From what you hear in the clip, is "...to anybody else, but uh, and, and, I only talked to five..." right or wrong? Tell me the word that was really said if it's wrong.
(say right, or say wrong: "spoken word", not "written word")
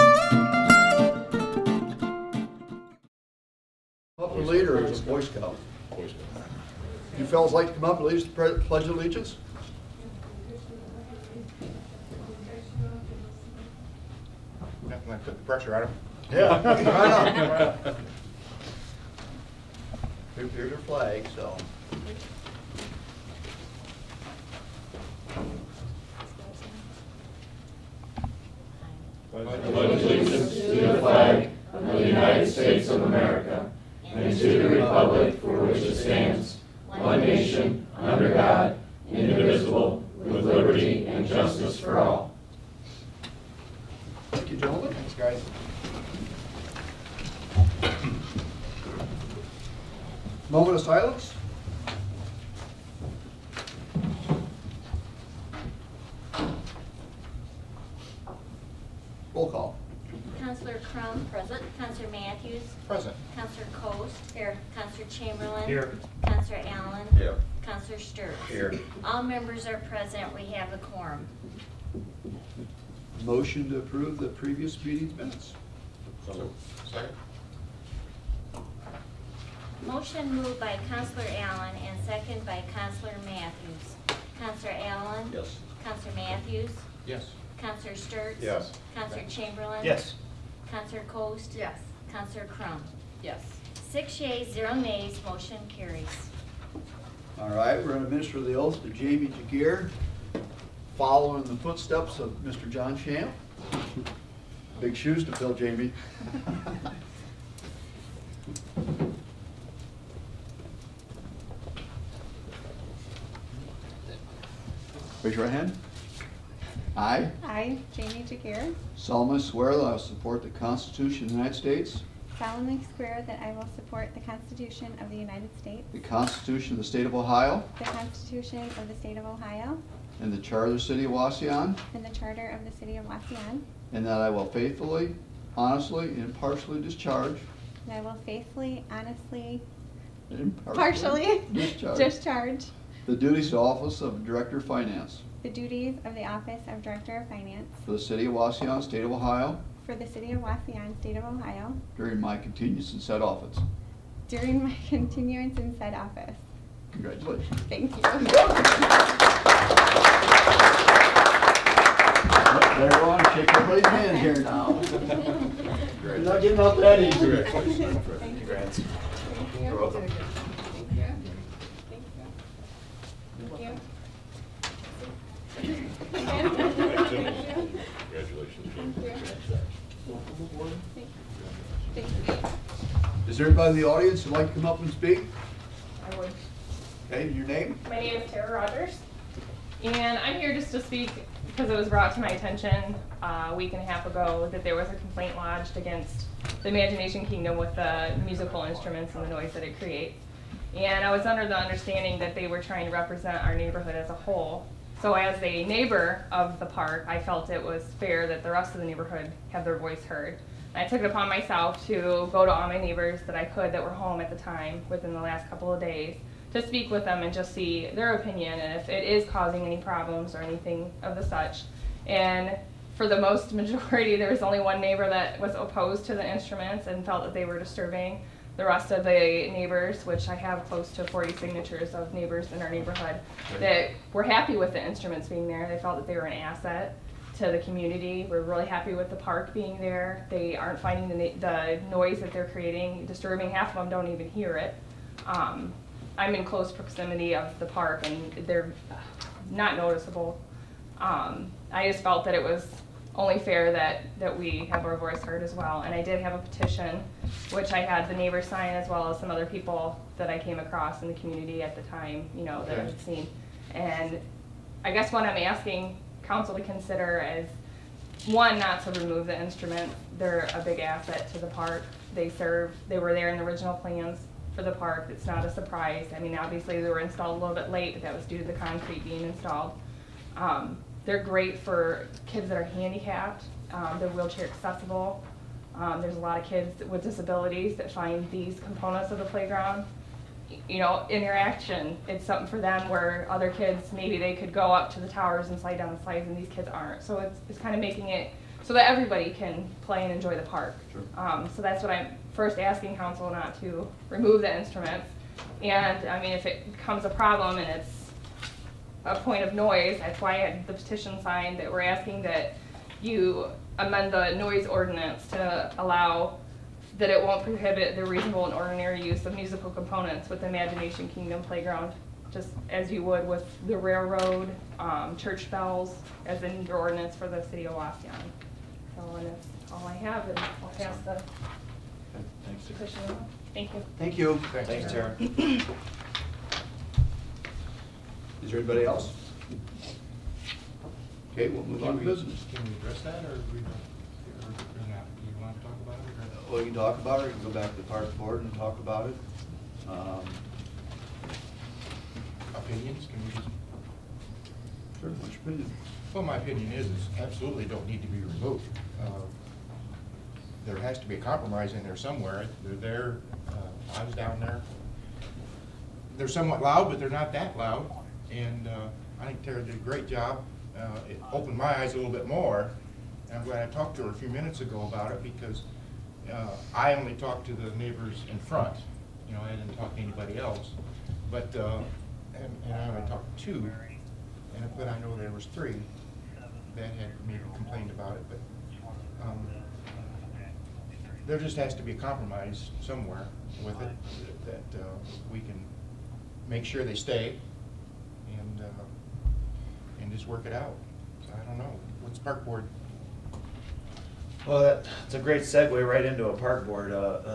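wrong: "two", not "five".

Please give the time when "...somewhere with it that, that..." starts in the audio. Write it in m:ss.
6:32.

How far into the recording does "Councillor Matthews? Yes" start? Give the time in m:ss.
1:25.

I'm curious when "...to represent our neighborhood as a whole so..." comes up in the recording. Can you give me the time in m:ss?
3:22.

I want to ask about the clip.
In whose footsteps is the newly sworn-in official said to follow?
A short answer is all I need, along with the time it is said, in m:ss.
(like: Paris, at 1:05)
John Champ, at 1:42.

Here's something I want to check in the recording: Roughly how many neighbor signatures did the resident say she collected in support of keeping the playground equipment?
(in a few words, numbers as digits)
40.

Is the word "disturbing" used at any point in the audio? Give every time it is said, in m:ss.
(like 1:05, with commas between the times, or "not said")
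3:47, 4:03.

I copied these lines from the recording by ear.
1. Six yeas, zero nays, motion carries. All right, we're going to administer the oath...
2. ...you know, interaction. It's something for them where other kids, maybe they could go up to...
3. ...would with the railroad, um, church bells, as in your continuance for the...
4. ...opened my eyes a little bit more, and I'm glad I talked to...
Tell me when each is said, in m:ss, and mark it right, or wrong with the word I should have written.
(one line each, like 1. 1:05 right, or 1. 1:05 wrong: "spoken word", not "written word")
1. 1:33 right
2. 4:50 right
3. 5:23 wrong: "ordinance", not "continuance"
4. 6:11 right.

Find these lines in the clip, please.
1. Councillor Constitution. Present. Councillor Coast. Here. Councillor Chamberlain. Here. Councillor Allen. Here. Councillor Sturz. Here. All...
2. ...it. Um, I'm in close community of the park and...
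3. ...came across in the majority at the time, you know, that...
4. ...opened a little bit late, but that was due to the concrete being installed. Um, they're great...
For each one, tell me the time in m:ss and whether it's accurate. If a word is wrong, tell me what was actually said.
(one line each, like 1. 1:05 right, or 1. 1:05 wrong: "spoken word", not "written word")
1. 1:01 wrong: "Matthews", not "Constitution"
2. 4:04 wrong: "proximity", not "community"
3. 4:20 wrong: "community", not "majority"
4. 4:37 wrong: "installed", not "opened".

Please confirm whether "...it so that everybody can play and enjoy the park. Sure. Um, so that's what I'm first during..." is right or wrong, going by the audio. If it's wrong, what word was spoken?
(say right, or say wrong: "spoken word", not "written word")
wrong: "asking", not "during".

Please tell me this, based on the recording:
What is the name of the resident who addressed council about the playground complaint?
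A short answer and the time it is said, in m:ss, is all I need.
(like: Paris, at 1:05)
Tara Rogers, at 3:08.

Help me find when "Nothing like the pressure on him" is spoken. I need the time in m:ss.
0:14.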